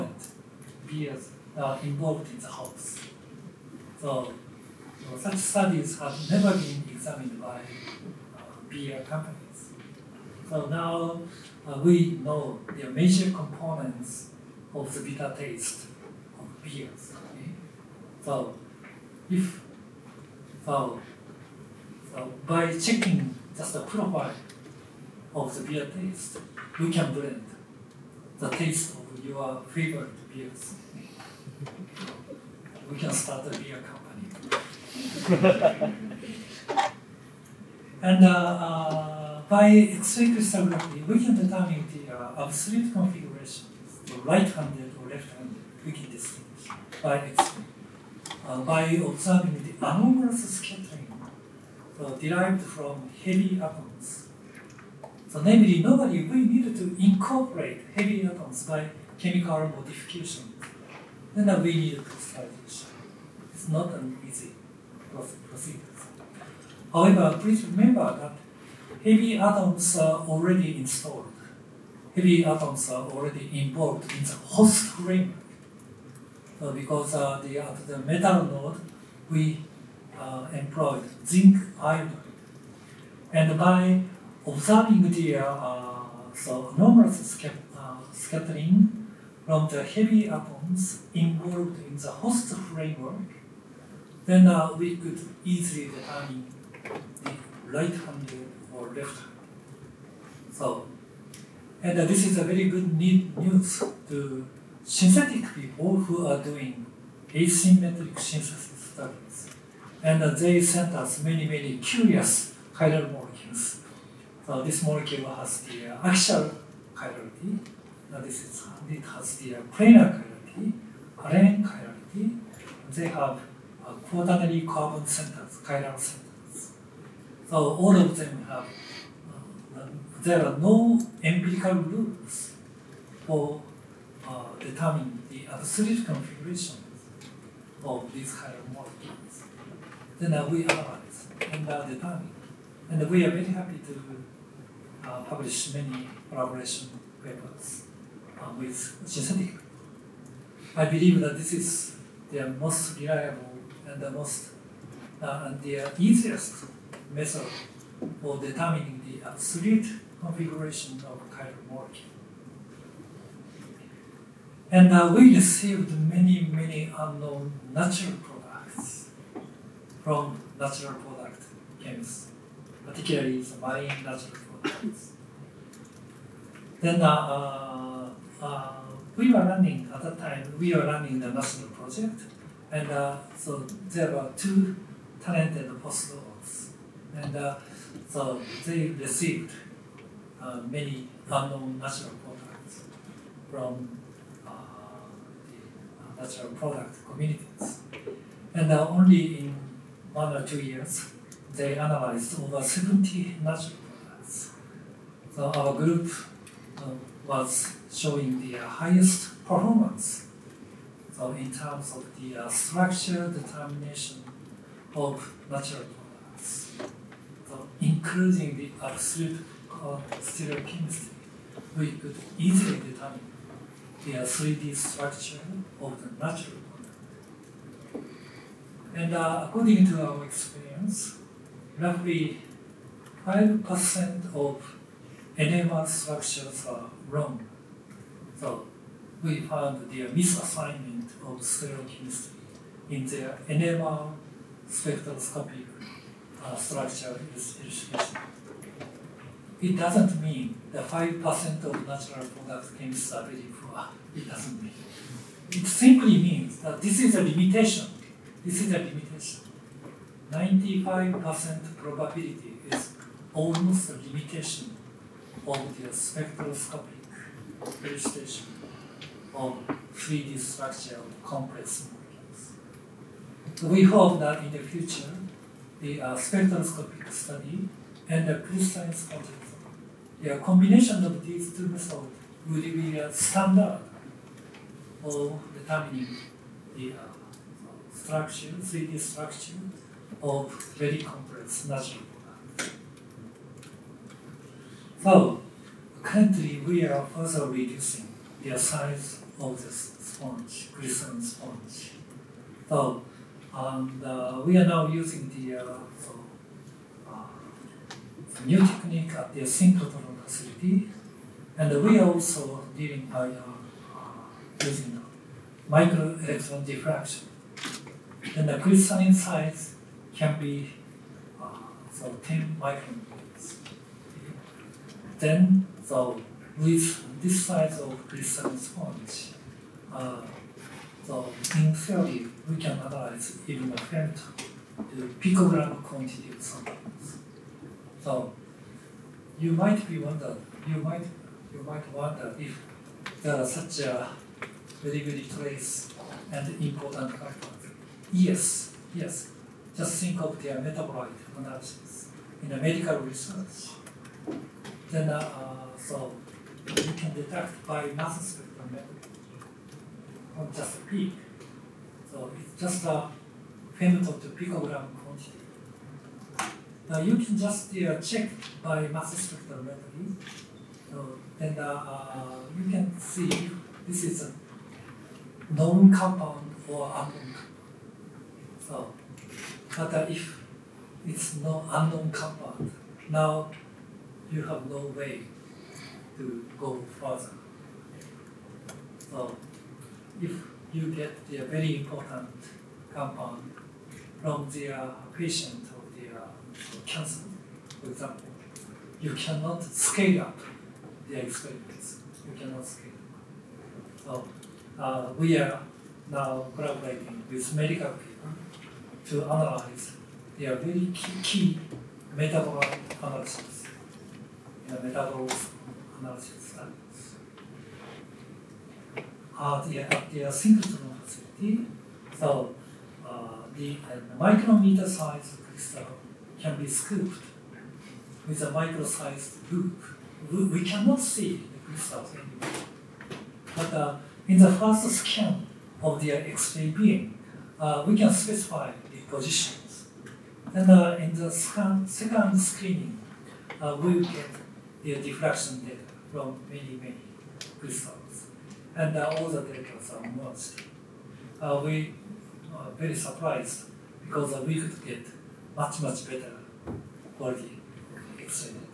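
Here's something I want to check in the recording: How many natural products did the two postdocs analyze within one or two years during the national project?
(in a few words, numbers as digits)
over 70.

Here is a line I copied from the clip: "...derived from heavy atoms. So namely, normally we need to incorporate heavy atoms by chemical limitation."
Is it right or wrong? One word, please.
wrong.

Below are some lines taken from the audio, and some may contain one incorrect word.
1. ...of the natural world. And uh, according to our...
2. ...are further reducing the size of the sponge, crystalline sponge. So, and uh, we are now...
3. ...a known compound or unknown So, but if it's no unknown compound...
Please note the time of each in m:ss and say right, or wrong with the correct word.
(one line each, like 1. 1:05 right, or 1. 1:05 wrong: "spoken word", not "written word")
1. 3:45 right
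2. 4:56 right
3. 6:14 right.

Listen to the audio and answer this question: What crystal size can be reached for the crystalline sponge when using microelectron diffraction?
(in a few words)
10 micrometers.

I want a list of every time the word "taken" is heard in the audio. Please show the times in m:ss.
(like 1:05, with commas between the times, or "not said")
not said.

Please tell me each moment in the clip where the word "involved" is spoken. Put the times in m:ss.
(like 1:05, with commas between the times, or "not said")
0:01, 1:13, 1:31.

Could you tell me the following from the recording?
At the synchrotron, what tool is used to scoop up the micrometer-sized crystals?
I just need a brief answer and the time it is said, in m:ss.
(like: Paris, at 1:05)
micro-sized loop, at 7:08.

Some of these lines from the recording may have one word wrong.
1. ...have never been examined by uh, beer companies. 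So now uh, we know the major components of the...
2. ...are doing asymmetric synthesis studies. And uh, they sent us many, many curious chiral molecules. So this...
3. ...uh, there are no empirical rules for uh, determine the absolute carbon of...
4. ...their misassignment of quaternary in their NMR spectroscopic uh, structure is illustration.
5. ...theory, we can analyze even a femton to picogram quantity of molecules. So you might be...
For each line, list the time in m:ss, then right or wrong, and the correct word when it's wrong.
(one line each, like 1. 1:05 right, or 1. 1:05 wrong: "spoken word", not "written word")
1. 0:05 right
2. 1:46 right
3. 2:09 wrong: "configuration", not "carbon"
4. 3:59 wrong: "stereochemistry", not "quaternary"
5. 5:31 wrong: "samples", not "molecules".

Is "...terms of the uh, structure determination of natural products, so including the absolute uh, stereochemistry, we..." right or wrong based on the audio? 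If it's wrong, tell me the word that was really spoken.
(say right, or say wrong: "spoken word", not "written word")
right.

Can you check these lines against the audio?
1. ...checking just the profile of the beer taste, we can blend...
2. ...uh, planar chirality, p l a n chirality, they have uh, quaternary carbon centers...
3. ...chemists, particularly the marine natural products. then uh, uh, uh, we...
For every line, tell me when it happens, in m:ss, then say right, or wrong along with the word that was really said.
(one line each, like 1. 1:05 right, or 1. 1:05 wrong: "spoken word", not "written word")
1. 0:22 right
2. 1:59 right
3. 2:51 right.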